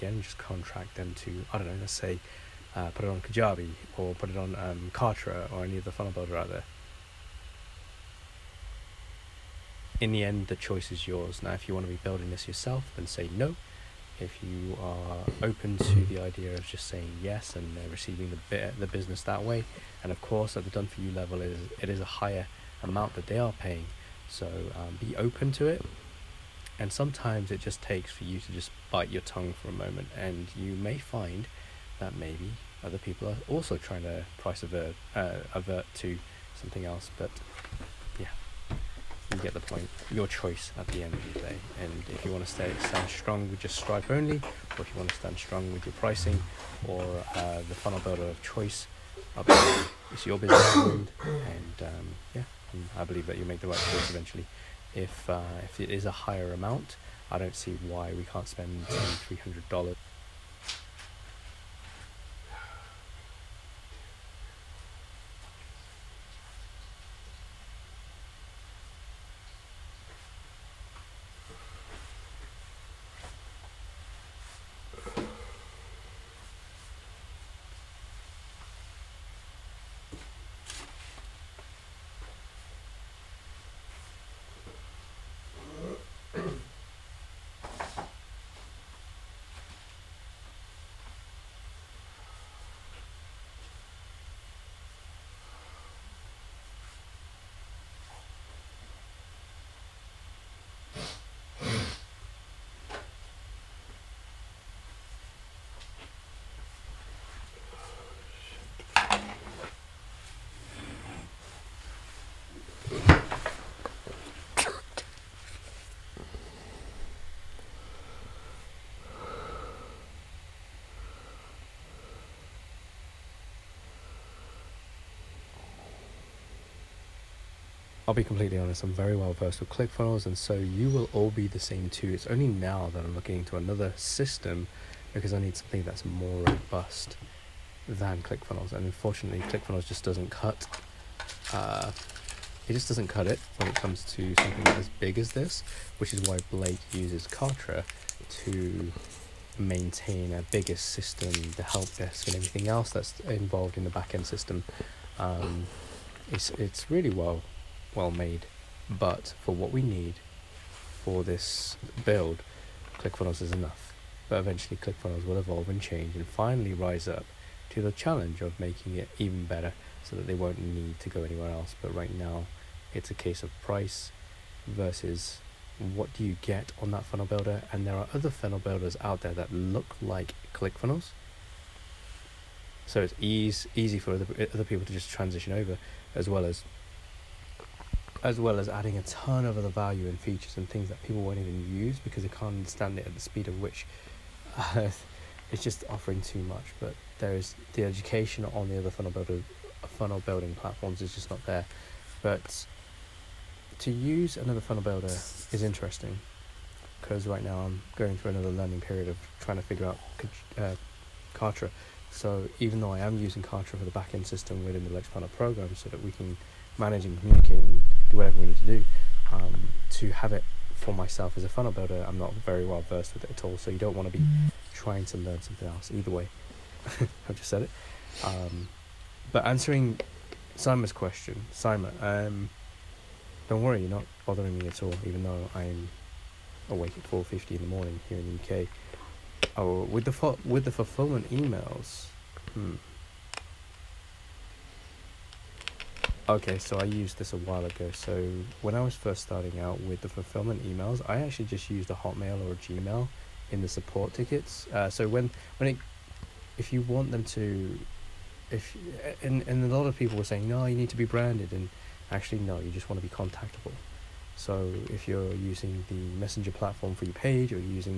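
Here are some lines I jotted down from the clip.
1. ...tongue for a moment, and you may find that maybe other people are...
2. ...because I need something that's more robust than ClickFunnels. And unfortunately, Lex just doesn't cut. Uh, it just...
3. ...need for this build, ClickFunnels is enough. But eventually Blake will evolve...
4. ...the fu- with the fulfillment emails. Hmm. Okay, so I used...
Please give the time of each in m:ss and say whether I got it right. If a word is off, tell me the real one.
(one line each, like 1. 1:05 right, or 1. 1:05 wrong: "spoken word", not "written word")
1. 0:29 right
2. 2:15 wrong: "ClickFunnels", not "Lex"
3. 2:39 wrong: "ClickFunnels", not "Blake"
4. 4:00 right.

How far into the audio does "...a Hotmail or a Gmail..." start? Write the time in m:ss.
4:11.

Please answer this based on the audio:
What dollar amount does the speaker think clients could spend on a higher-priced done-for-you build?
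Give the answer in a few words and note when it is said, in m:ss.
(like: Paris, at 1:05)
$300, at 0:58.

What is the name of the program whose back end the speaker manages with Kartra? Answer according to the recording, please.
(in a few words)
Lex.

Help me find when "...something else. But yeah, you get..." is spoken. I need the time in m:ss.
0:36.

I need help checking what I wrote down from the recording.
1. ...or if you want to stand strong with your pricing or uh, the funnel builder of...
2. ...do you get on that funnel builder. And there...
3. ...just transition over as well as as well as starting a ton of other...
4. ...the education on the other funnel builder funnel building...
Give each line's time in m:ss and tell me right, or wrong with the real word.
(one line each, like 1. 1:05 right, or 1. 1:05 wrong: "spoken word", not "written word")
1. 0:44 right
2. 2:56 right
3. 3:04 wrong: "adding", not "starting"
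4. 3:17 right.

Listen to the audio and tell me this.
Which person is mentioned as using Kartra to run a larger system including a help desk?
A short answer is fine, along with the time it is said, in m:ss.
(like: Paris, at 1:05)
Blake, at 2:26.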